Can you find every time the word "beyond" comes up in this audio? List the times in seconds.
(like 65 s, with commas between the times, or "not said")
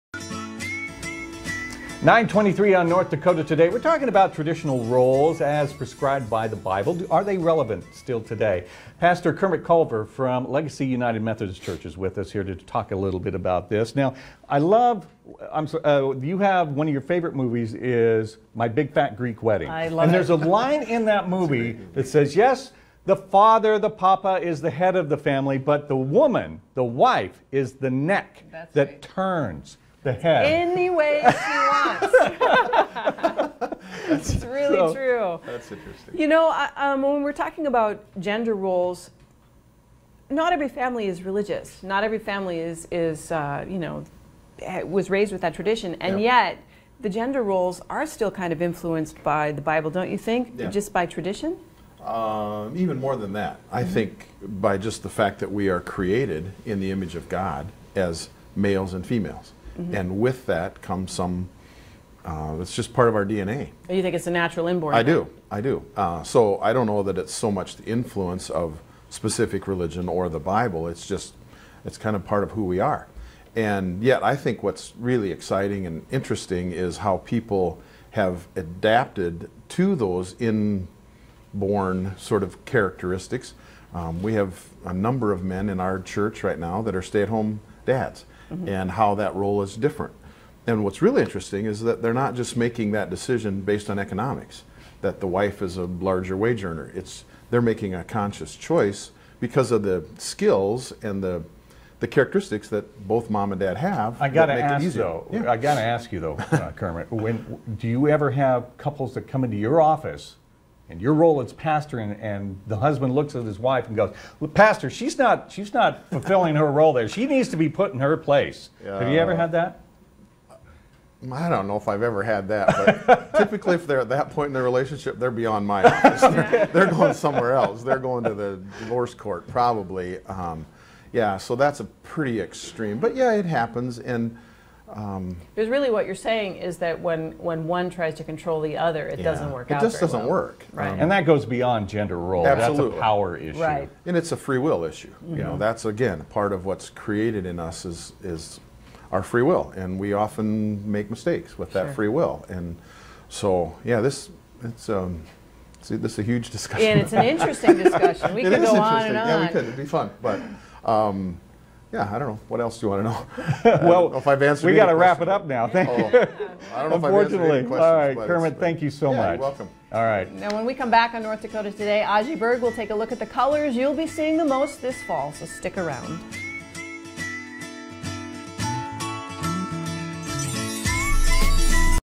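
125 s, 141 s.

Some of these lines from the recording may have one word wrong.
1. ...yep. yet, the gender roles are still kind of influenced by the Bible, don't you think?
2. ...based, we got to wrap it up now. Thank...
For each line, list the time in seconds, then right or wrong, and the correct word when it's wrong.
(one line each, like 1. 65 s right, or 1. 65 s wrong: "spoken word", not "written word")
1. 46 s right
2. 164 s wrong: "answered", not "based".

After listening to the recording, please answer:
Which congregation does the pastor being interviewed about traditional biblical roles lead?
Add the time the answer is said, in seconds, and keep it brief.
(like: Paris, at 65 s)
Legacy United Methodist Church, at 10 s.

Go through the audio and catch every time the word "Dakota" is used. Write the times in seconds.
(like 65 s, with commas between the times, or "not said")
3 s, 171 s.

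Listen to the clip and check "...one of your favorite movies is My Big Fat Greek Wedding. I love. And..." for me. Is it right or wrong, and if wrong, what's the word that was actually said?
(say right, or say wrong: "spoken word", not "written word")
right.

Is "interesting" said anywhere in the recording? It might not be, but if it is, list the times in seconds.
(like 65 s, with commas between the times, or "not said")
35 s, 76 s, 91 s, 157 s.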